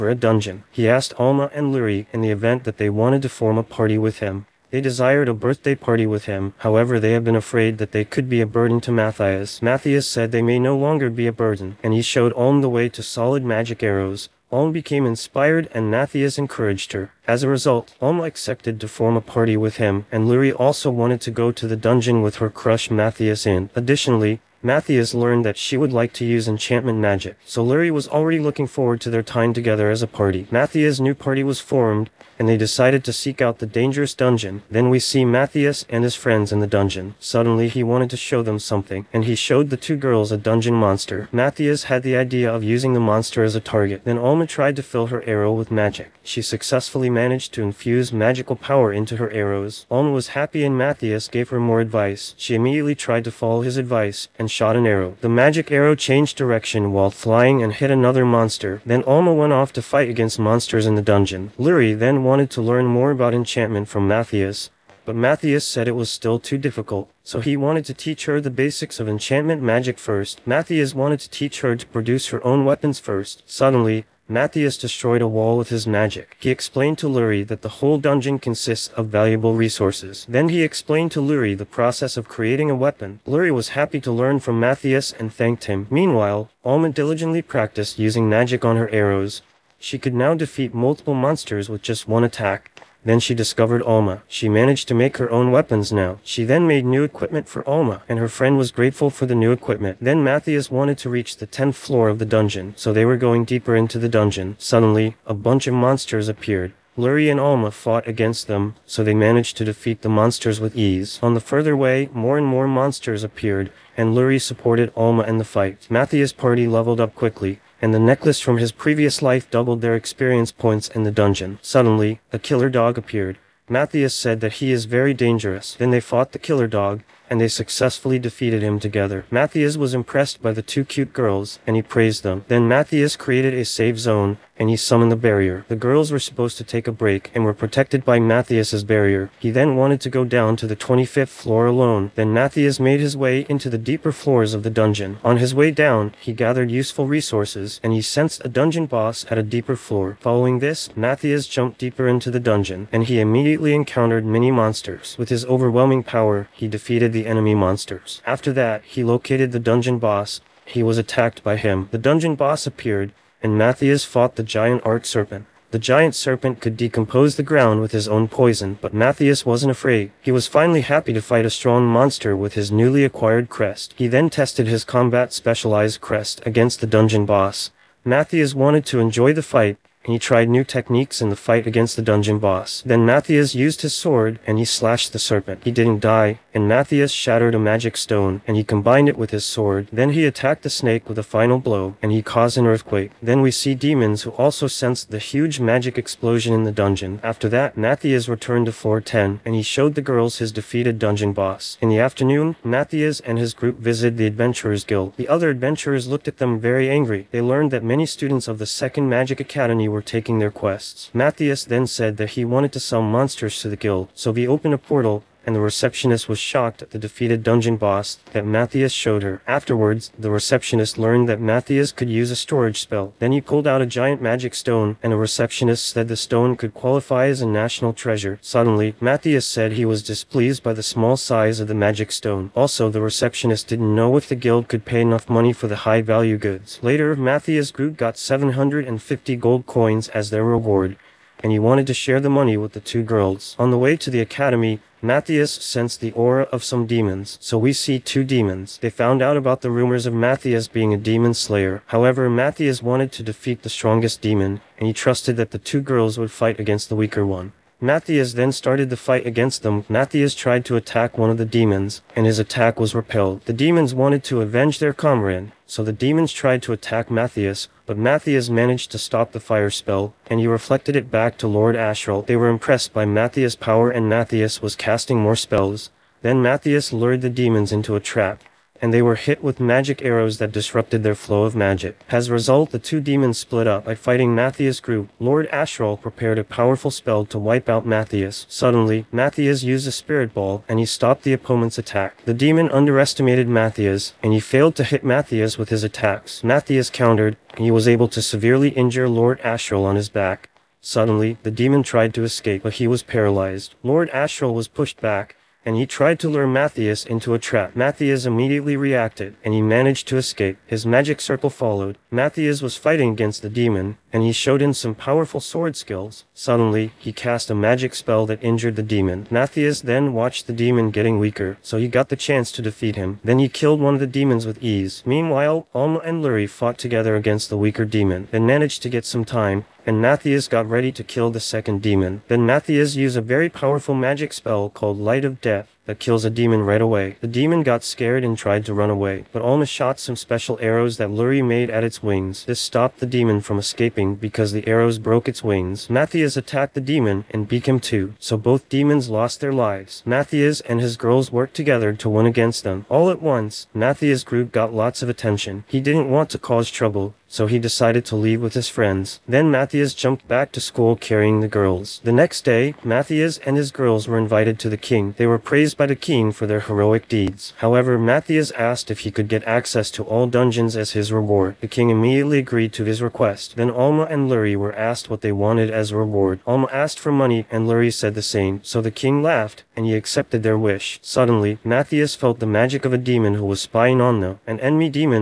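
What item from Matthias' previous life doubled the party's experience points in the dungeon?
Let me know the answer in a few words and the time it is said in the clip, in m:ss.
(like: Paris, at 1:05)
Necklace, at 1:57.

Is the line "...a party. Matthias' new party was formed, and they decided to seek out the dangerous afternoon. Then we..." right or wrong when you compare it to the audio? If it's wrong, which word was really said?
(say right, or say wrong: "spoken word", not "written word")
wrong: "dungeon", not "afternoon".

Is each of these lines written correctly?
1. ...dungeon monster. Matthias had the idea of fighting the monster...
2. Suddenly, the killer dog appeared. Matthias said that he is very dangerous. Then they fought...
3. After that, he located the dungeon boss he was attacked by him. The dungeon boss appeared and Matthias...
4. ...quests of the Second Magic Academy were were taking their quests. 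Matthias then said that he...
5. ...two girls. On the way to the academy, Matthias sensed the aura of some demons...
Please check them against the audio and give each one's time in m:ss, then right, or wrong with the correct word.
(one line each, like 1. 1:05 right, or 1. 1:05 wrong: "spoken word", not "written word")
1. 0:40 wrong: "using", not "fighting"
2. 2:01 right
3. 2:38 right
4. 3:28 wrong: "students", not "quests"
5. 4:02 right.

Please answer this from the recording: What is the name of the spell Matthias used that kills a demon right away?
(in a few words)
Light of Death.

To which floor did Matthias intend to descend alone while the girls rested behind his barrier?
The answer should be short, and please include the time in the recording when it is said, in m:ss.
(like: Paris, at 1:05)
25th floor, at 2:20.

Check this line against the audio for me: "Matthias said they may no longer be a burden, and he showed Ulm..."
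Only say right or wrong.
right.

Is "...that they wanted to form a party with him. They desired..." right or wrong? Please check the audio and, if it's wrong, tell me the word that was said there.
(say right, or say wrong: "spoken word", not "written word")
right.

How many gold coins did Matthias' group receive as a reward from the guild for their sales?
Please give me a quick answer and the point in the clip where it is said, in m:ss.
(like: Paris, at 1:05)
750, at 3:58.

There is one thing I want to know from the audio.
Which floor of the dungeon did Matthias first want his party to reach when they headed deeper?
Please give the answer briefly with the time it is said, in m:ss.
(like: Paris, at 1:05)
10th floor, at 1:41.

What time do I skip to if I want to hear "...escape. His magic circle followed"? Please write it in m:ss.
5:10.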